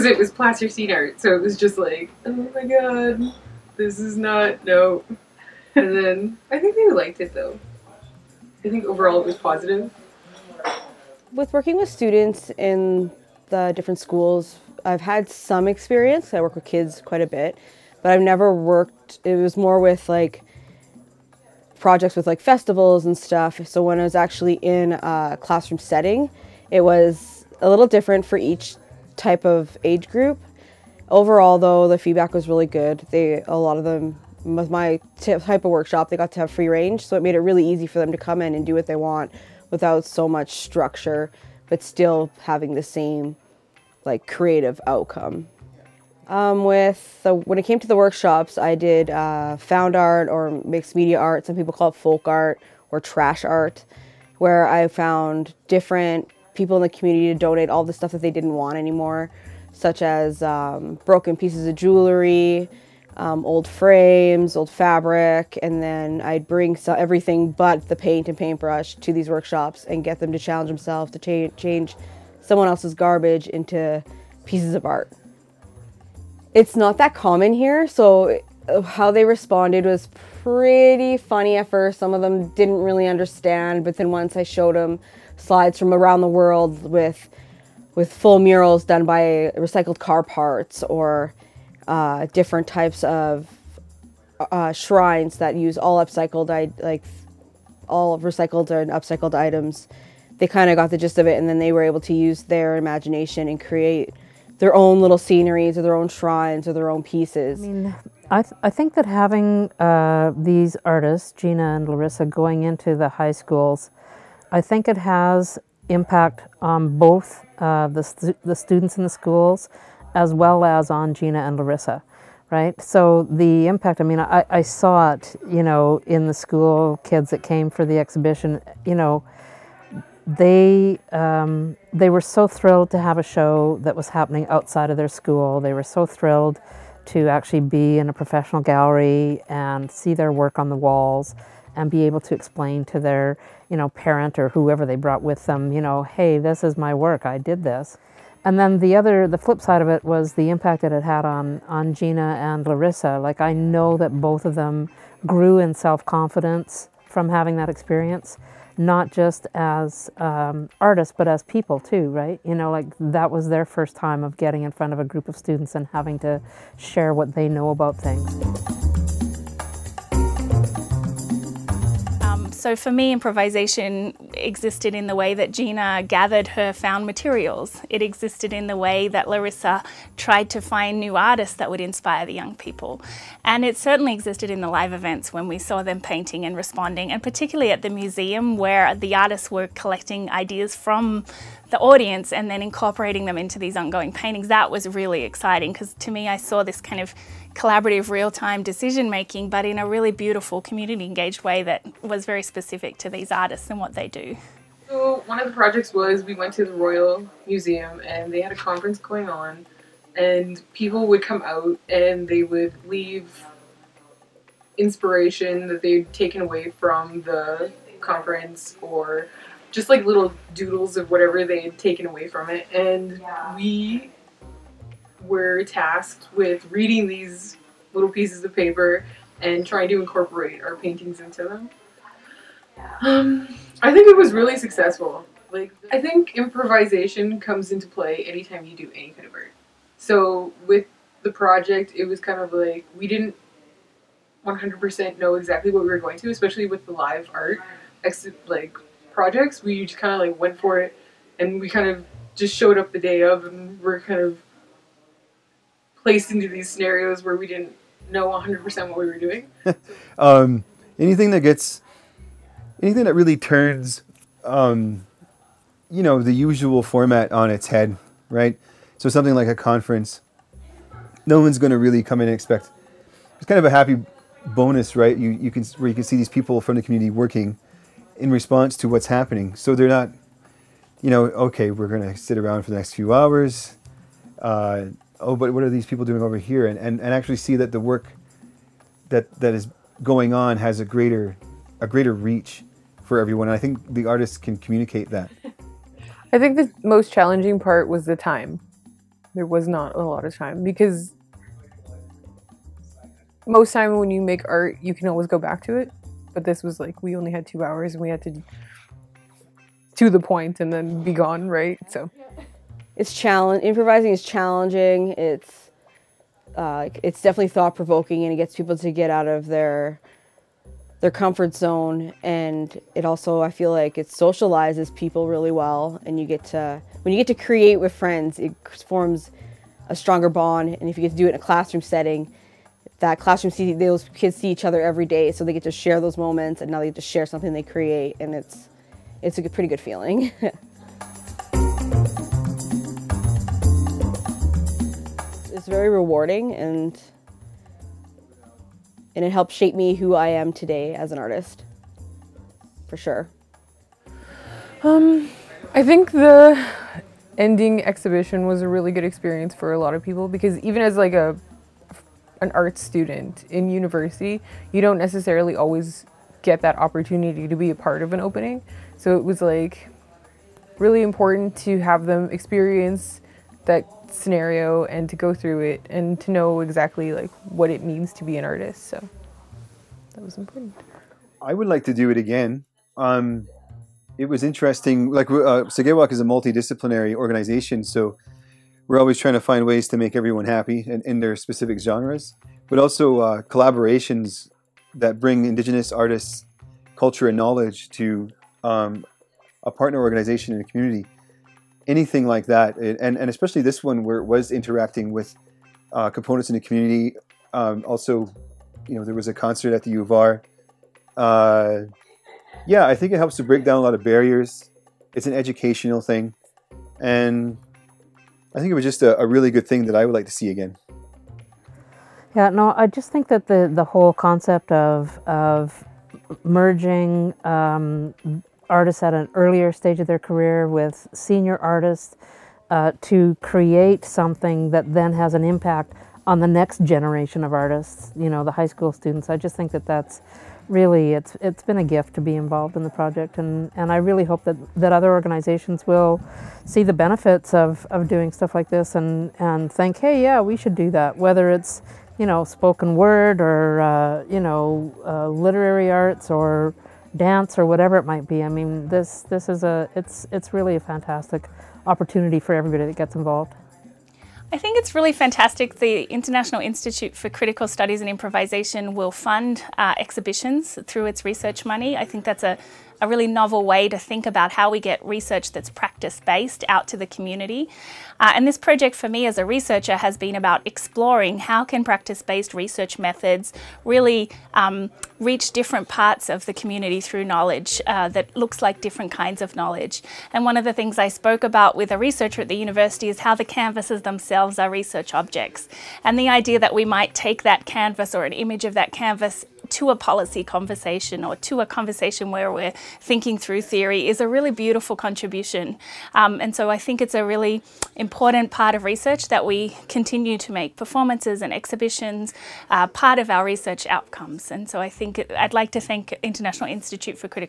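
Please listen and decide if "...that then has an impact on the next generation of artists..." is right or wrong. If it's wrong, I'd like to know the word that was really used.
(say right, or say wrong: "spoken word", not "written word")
right.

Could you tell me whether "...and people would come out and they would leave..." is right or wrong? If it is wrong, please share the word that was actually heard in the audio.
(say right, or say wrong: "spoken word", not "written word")
right.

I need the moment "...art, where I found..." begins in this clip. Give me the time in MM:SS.
00:53.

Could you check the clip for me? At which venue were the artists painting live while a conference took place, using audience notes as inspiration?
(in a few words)
Royal Museum.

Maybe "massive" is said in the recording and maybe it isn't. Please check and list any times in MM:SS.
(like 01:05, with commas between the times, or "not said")
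not said.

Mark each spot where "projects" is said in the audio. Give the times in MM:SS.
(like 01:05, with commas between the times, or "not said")
00:21, 03:25, 04:01, 04:09, 07:22, 07:58.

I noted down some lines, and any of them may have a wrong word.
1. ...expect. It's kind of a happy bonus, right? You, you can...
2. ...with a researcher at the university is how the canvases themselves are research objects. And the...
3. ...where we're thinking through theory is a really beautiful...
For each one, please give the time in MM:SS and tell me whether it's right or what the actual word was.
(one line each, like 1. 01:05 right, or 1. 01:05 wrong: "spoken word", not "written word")
1. 04:32 right
2. 08:11 right
3. 08:22 right.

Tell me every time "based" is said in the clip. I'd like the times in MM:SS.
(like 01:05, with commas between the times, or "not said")
07:56, 08:02.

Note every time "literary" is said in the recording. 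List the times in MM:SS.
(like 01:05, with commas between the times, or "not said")
07:35.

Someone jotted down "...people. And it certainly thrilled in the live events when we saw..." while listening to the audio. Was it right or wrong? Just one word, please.
wrong.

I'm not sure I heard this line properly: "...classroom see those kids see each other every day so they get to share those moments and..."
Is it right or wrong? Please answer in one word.
right.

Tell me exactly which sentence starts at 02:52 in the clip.
So for me, improvisation existed in the way that Gina gathered her found materials.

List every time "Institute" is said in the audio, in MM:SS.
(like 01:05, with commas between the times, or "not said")
07:46, 08:36.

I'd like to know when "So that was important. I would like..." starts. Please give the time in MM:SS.
06:18.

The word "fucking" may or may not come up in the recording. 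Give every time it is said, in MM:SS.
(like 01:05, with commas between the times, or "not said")
not said.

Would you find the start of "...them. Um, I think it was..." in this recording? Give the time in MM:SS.
03:51.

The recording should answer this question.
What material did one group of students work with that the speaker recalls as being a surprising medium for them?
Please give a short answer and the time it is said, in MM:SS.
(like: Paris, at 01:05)
Plasticine, at 00:00.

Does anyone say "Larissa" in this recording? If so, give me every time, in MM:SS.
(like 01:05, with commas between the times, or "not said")
01:51, 02:01, 02:32, 02:59.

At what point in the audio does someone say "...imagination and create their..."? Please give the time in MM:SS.
01:42.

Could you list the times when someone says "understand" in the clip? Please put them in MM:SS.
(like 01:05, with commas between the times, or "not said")
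01:23.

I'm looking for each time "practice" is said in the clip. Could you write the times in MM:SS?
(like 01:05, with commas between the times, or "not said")
07:55, 08:01.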